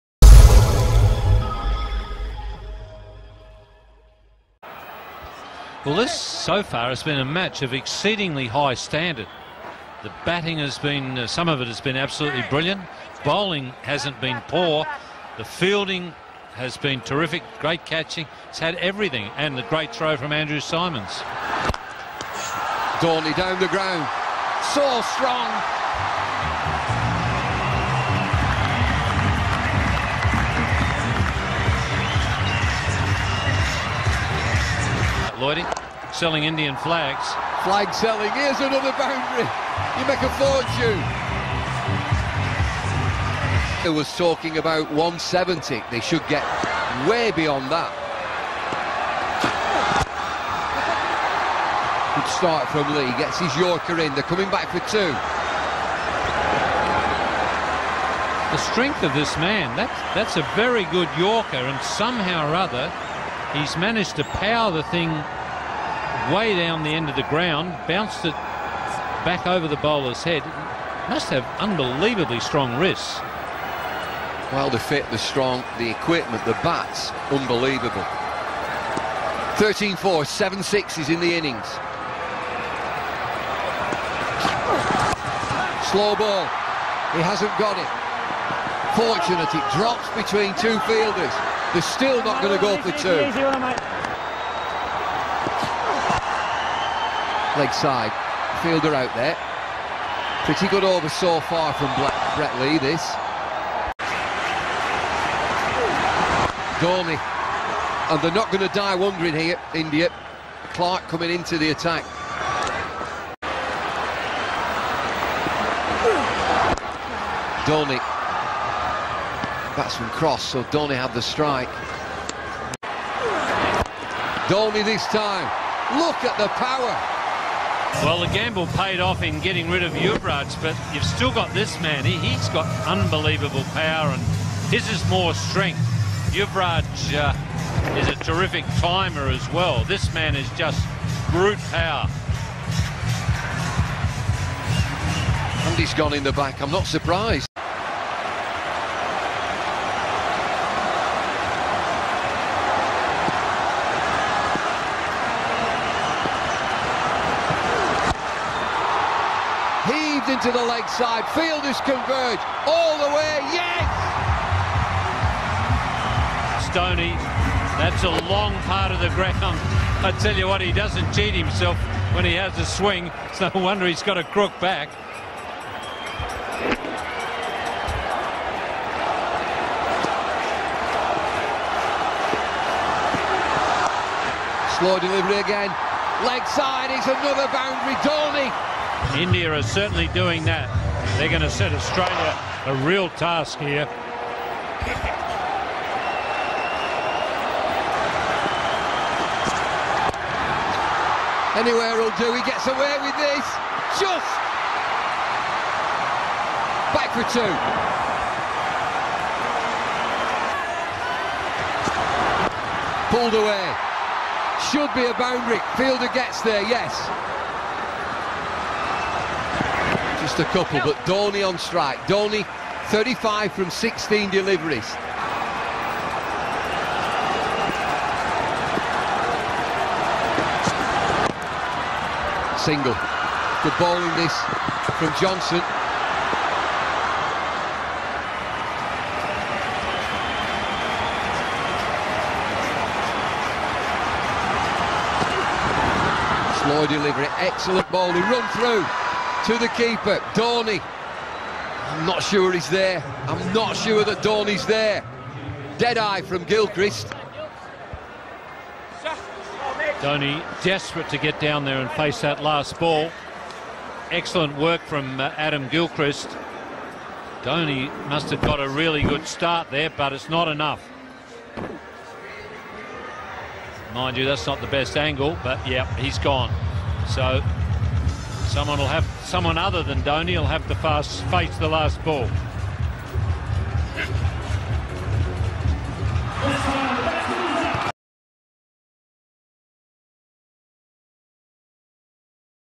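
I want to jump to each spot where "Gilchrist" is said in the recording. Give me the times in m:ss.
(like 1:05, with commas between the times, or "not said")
4:16, 4:25.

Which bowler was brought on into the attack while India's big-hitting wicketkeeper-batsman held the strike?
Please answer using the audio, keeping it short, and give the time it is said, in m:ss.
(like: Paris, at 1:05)
Clark, at 1:50.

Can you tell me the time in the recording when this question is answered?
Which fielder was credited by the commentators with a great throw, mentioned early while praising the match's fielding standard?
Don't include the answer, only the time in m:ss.
0:20.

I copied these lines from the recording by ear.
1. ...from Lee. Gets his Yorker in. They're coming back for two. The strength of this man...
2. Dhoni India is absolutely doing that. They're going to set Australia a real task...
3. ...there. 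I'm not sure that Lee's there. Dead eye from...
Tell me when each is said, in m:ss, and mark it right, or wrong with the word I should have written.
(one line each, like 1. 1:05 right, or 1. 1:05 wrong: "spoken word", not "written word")
1. 0:52 right
2. 3:08 wrong: "certainly", not "absolutely"
3. 4:12 wrong: "Dhoni", not "Lee".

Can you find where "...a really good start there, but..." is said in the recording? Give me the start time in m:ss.
4:28.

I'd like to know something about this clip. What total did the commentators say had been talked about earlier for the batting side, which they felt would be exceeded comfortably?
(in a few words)
170.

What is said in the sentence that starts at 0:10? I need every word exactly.
The batting has been, uh, some of it has been absolutely brilliant.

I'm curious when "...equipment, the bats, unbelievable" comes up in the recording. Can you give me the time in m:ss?
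1:15.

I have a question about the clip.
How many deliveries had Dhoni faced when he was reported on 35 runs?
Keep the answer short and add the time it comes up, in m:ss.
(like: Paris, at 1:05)
16, at 3:43.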